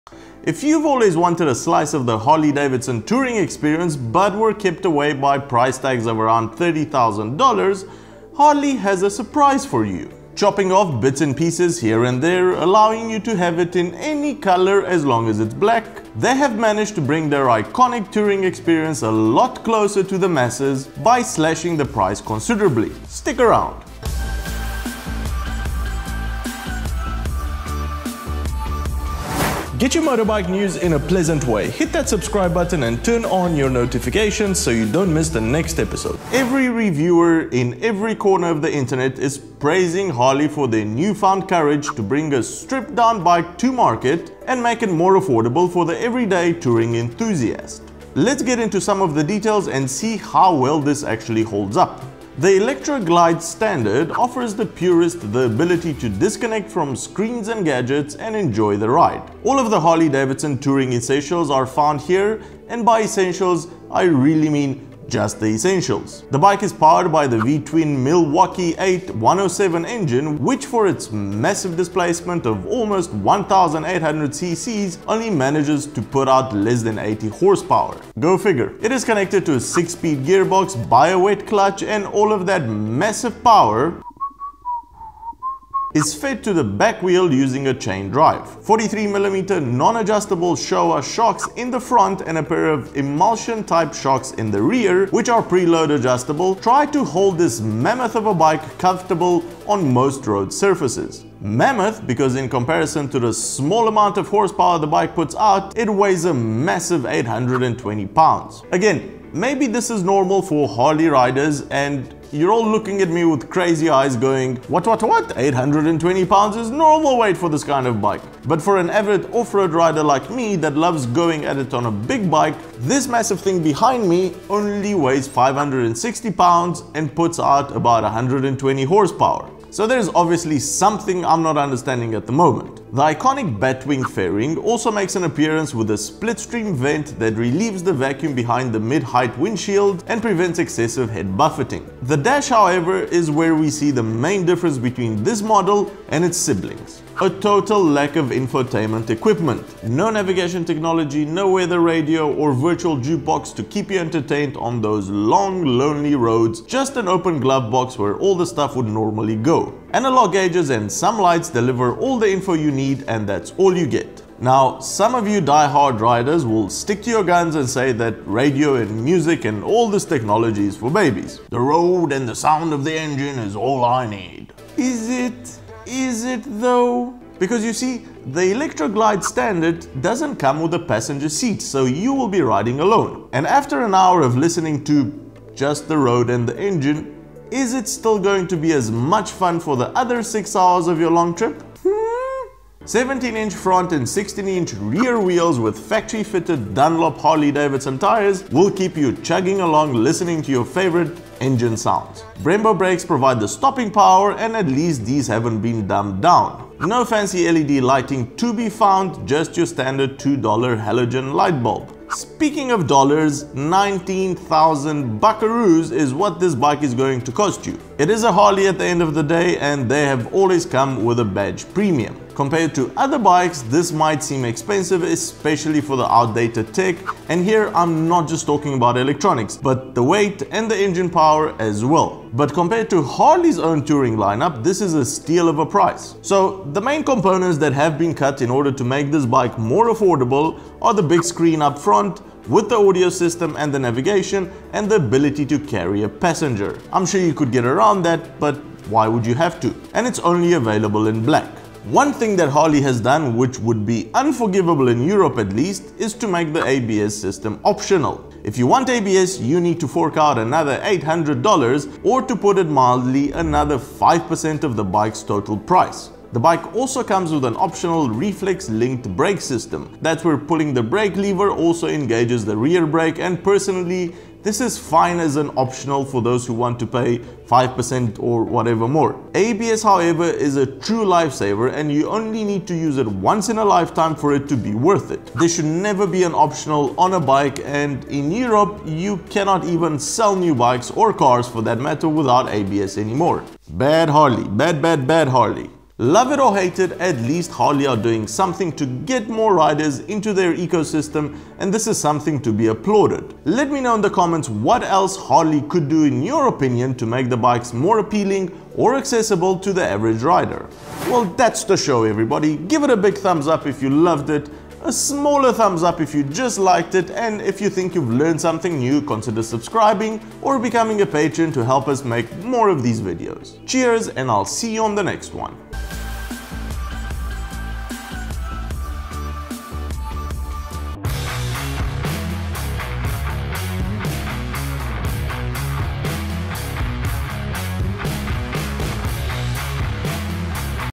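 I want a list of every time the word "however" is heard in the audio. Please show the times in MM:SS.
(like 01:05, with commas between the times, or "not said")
02:22, 04:39.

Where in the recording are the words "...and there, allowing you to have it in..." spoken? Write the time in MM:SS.
00:12.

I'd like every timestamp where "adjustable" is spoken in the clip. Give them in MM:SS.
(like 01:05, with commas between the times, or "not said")
01:29, 01:35.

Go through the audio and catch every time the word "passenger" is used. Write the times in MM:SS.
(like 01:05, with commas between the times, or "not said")
03:00, 04:06.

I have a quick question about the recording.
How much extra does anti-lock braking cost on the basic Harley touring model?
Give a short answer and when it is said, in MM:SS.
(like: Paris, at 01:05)
$800, at 04:20.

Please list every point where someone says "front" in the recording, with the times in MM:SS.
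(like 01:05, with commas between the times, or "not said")
01:31, 03:13, 04:01.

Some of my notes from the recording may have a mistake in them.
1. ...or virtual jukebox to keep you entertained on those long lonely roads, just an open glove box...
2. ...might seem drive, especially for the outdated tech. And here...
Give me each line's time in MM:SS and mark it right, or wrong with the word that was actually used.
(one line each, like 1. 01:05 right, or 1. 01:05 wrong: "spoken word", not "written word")
1. 02:32 right
2. 03:43 wrong: "expensive", not "drive".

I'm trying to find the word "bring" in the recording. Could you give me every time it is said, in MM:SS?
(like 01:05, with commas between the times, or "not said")
00:17, 00:42.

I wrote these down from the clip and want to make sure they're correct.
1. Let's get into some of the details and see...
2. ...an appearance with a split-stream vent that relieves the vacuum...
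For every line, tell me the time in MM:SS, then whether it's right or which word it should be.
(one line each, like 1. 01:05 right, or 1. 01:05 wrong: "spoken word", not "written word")
1. 00:48 right
2. 02:15 right.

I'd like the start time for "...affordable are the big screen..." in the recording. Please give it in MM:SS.
03:59.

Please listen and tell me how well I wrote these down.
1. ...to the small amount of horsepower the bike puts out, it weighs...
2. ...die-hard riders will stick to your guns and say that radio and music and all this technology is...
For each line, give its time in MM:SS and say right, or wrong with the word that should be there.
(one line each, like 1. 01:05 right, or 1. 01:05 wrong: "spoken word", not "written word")
1. 01:43 right
2. 02:45 right.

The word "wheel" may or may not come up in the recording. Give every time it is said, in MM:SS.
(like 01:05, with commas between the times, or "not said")
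01:27, 03:15.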